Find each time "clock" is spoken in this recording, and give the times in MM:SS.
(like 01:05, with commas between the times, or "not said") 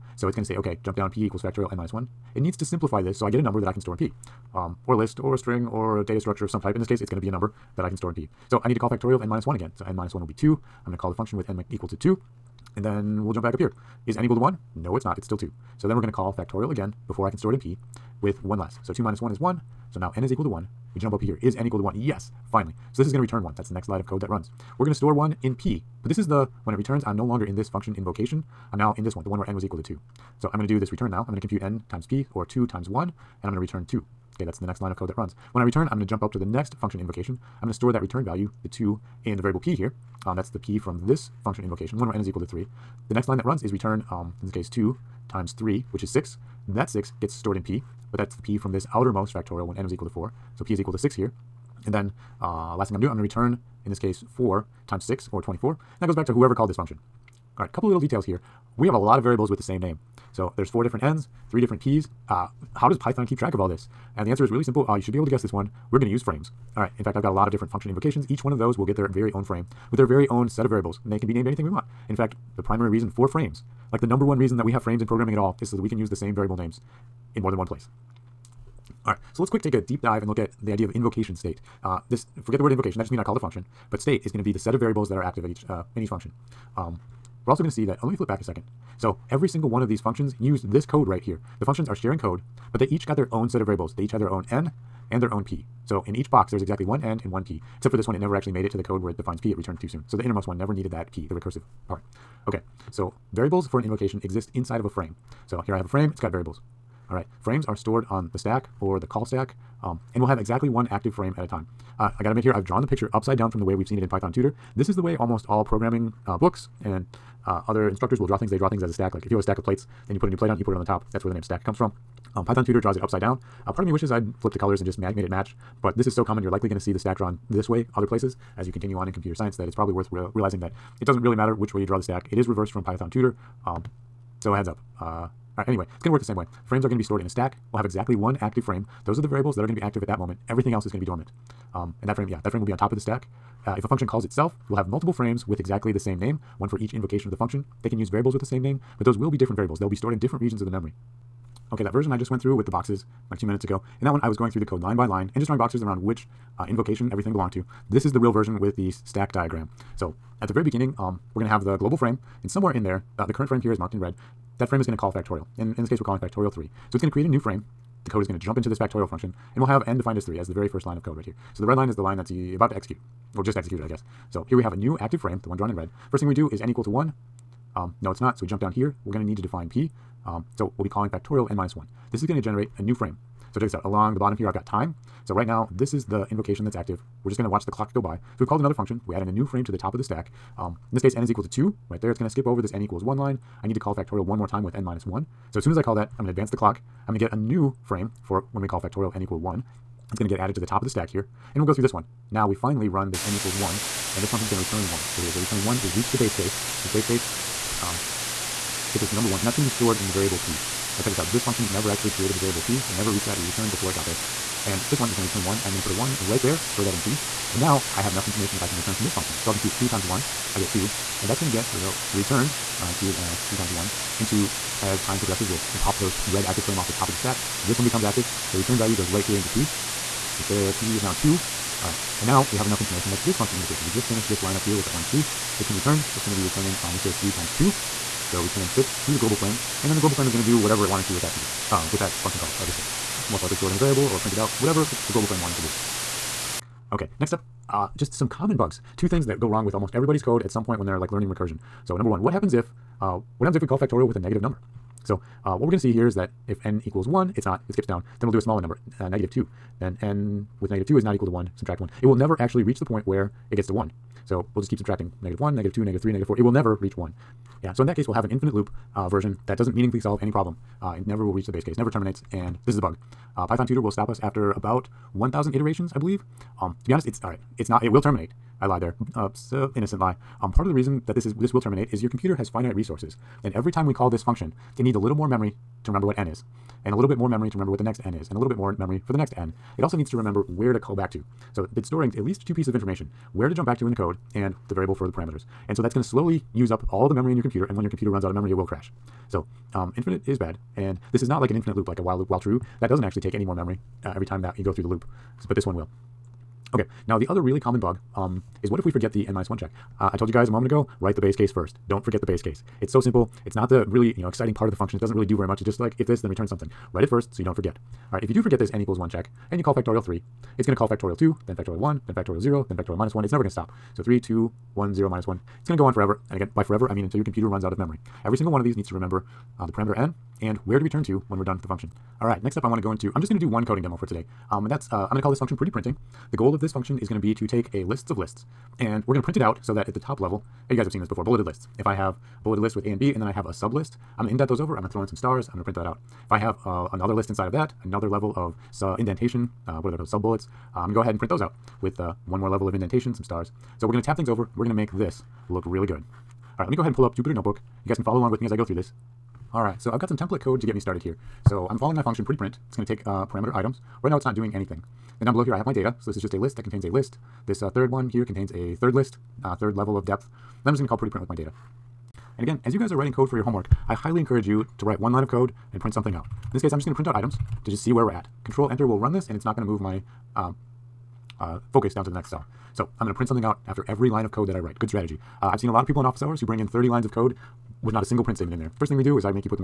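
03:07, 03:16.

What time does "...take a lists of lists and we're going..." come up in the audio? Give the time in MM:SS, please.
05:37.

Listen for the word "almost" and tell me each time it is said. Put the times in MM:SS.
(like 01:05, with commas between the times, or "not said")
01:55, 04:09.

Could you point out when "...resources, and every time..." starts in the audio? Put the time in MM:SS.
04:42.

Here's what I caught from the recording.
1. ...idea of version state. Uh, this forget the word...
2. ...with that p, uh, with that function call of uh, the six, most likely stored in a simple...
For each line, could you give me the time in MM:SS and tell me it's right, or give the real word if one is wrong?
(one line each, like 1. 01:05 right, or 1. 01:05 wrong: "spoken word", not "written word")
1. 01:20 wrong: "invocation", not "version"
2. 04:01 wrong: "variable", not "simple".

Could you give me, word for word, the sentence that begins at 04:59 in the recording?
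So um, infinite is bad, and this is not like an infinite loop, like a while loop while true.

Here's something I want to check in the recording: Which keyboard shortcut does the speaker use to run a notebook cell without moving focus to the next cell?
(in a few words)
Control Enter.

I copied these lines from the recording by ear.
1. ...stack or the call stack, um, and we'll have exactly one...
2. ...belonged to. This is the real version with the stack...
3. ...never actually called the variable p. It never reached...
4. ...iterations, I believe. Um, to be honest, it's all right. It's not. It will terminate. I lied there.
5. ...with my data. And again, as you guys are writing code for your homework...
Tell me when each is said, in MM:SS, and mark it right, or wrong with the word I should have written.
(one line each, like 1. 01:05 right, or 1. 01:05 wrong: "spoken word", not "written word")
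1. 01:48 right
2. 02:37 right
3. 03:31 wrong: "created", not "called"
4. 04:35 right
5. 06:11 right.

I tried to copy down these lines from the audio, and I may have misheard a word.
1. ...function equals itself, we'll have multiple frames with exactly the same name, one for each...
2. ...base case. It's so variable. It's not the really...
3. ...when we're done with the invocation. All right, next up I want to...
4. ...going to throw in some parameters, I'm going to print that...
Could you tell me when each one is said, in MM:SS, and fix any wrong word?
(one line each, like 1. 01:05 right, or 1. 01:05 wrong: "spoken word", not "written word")
1. 02:23 wrong: "calls", not "equals"
2. 05:12 wrong: "simple", not "variable"
3. 05:31 wrong: "function", not "invocation"
4. 05:44 wrong: "stars", not "parameters".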